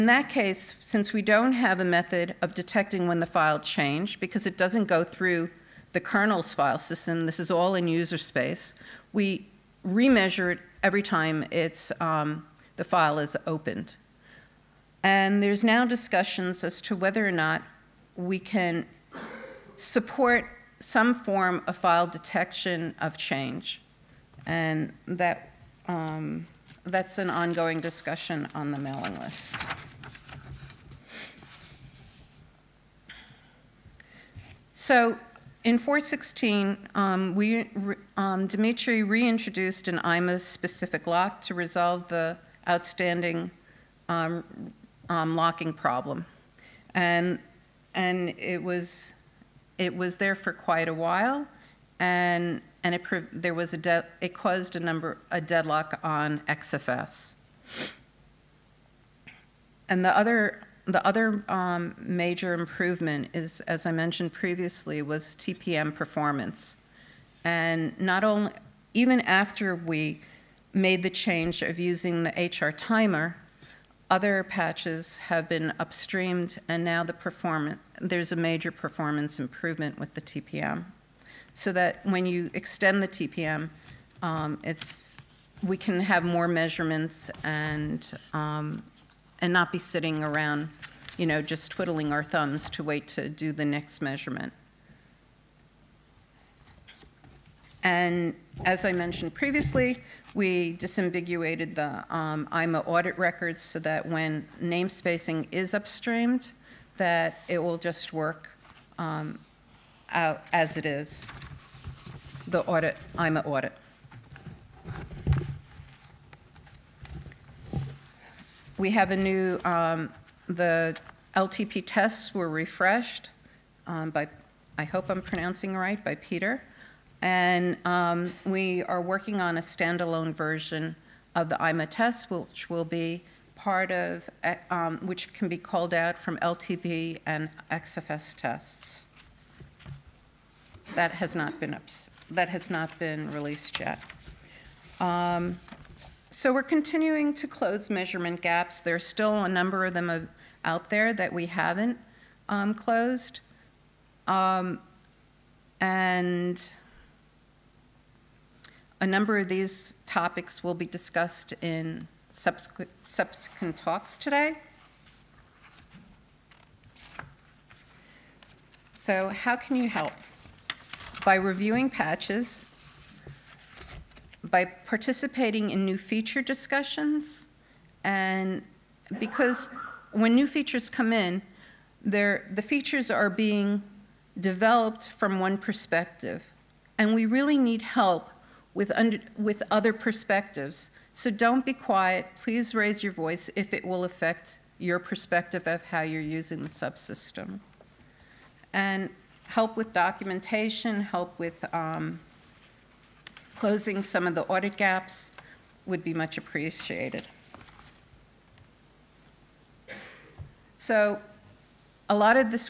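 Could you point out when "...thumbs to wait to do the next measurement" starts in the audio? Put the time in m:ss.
1:32.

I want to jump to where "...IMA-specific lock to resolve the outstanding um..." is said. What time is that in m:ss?
0:40.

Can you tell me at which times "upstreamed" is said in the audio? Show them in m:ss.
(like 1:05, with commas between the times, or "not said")
1:15, 1:45.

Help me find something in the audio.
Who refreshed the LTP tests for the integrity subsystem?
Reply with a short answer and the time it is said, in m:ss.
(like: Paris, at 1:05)
Peter, at 2:06.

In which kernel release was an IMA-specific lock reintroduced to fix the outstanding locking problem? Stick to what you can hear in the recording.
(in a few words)
4.16.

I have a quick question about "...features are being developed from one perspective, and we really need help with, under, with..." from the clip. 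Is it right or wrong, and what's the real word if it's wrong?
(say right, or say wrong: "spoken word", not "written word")
right.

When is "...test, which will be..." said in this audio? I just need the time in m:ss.
2:11.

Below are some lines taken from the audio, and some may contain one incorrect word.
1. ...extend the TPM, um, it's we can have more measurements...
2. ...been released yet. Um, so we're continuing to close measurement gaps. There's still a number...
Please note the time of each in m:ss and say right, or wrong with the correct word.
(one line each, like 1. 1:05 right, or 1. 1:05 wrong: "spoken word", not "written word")
1. 1:22 right
2. 2:22 right.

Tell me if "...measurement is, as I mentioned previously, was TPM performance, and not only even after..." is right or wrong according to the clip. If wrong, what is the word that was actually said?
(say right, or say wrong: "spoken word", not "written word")
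wrong: "improvement", not "measurement".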